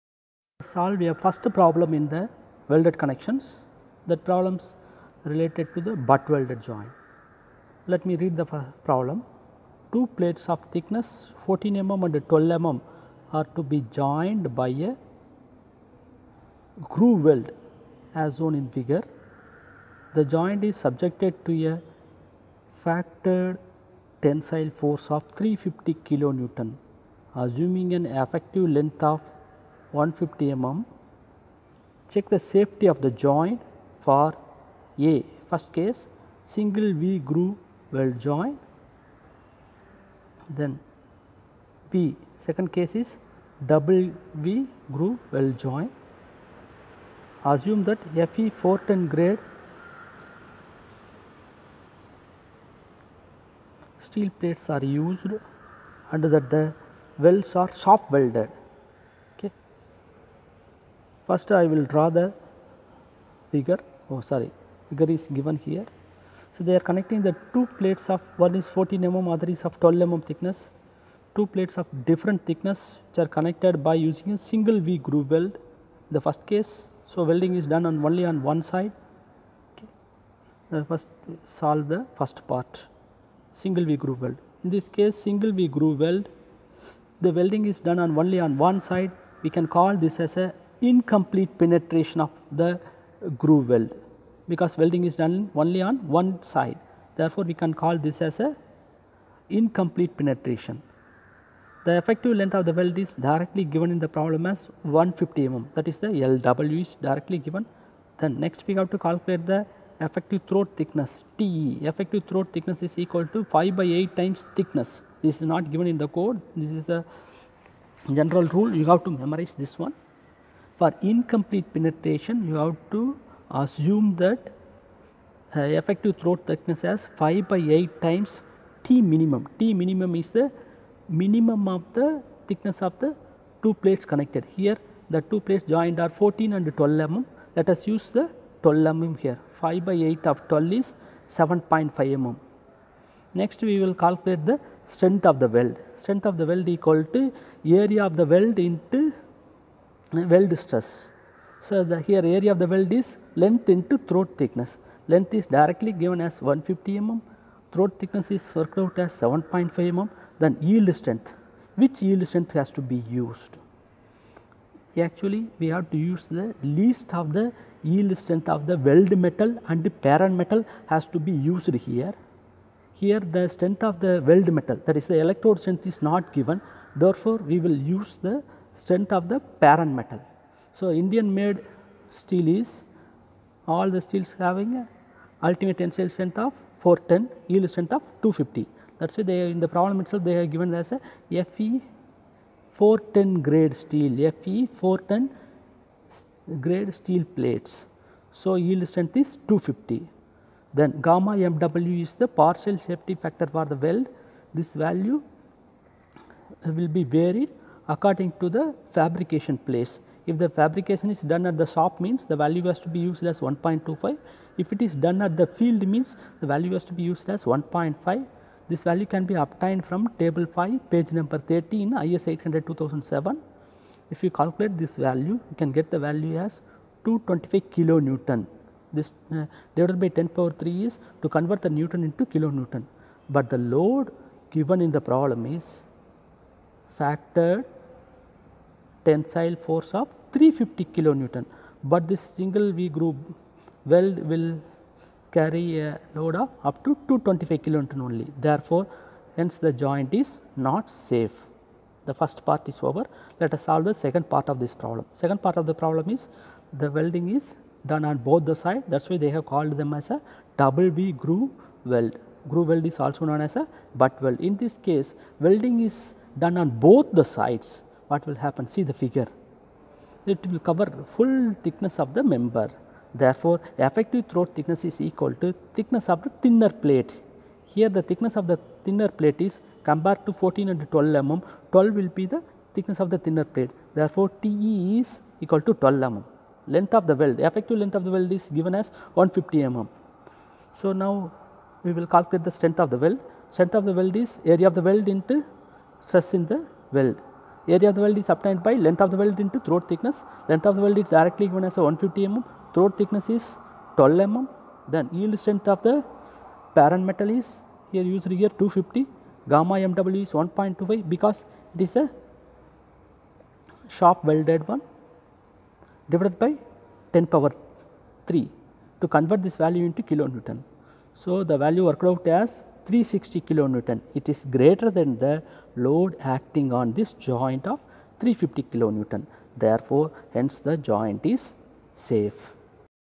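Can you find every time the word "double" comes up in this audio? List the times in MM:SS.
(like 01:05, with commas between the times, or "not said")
00:43, 04:20.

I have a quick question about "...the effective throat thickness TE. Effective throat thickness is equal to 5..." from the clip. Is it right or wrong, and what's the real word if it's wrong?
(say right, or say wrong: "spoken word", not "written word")
right.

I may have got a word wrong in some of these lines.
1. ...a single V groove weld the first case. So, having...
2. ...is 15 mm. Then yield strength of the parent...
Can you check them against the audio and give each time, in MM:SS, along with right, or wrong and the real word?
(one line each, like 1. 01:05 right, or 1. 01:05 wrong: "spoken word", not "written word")
1. 01:14 wrong: "welding", not "having"
2. 05:03 wrong: "12", not "15".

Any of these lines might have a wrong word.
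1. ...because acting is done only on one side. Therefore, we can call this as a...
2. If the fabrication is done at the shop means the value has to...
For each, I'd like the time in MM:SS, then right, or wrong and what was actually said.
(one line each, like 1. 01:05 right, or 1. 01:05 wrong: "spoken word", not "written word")
1. 01:34 wrong: "welding", not "acting"
2. 03:30 right.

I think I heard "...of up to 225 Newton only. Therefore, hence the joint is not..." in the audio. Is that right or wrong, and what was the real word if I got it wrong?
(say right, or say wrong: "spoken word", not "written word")
right.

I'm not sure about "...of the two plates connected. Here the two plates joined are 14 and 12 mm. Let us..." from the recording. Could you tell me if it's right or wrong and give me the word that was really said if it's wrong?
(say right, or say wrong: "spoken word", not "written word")
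right.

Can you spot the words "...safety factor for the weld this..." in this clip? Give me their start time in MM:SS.
03:22.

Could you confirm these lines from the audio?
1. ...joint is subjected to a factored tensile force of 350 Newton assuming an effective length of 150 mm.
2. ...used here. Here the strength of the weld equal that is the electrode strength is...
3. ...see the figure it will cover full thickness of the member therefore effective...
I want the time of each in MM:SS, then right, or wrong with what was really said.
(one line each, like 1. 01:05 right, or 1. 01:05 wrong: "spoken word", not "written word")
1. 00:20 right
2. 02:51 wrong: "metal", not "equal"
3. 04:28 right.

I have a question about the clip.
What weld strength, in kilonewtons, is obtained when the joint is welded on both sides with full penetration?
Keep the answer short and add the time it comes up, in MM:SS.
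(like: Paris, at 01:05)
360 kN, at 05:22.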